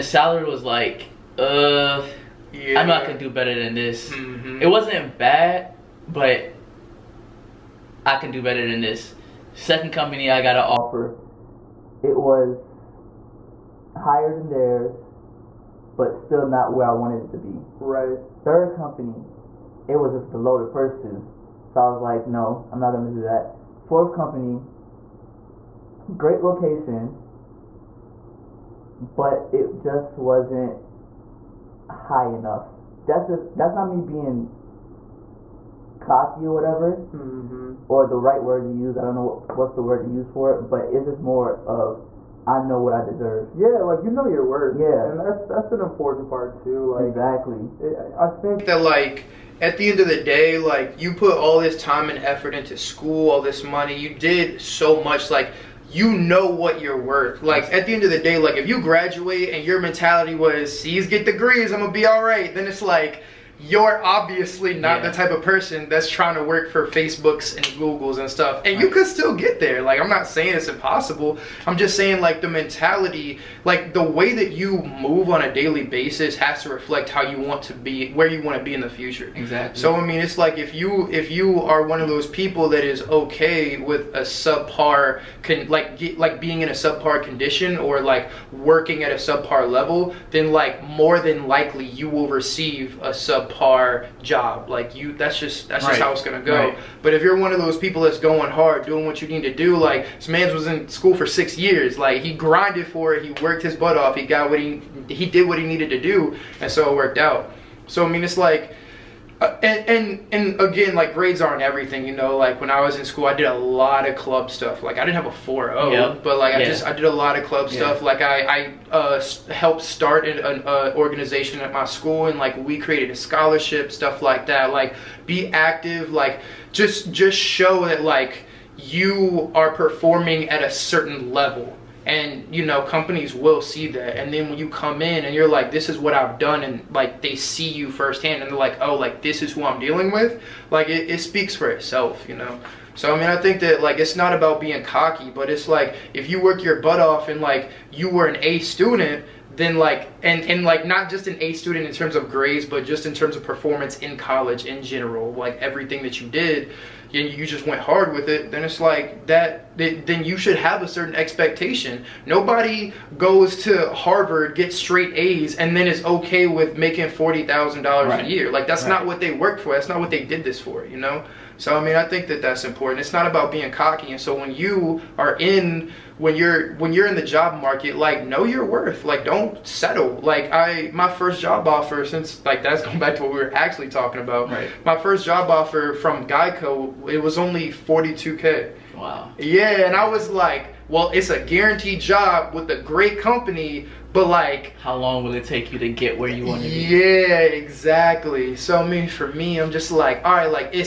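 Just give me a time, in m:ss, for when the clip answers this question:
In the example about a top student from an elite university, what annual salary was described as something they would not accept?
2:47.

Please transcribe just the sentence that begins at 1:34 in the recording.
Like you, that's just that's right.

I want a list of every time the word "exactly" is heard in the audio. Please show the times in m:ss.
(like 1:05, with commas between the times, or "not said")
0:47, 1:19, 3:17.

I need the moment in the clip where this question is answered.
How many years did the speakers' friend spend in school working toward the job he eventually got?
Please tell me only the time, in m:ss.
1:41.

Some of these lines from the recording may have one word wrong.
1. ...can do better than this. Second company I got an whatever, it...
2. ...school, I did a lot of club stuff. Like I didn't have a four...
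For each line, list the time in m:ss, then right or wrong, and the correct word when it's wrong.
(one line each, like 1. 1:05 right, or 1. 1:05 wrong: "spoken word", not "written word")
1. 0:08 wrong: "offer", not "whatever"
2. 1:53 right.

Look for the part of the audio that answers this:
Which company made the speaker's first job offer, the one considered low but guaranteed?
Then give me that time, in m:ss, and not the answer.
3:06.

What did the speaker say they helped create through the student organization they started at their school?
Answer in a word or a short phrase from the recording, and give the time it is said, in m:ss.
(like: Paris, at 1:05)
A scholarship, at 2:03.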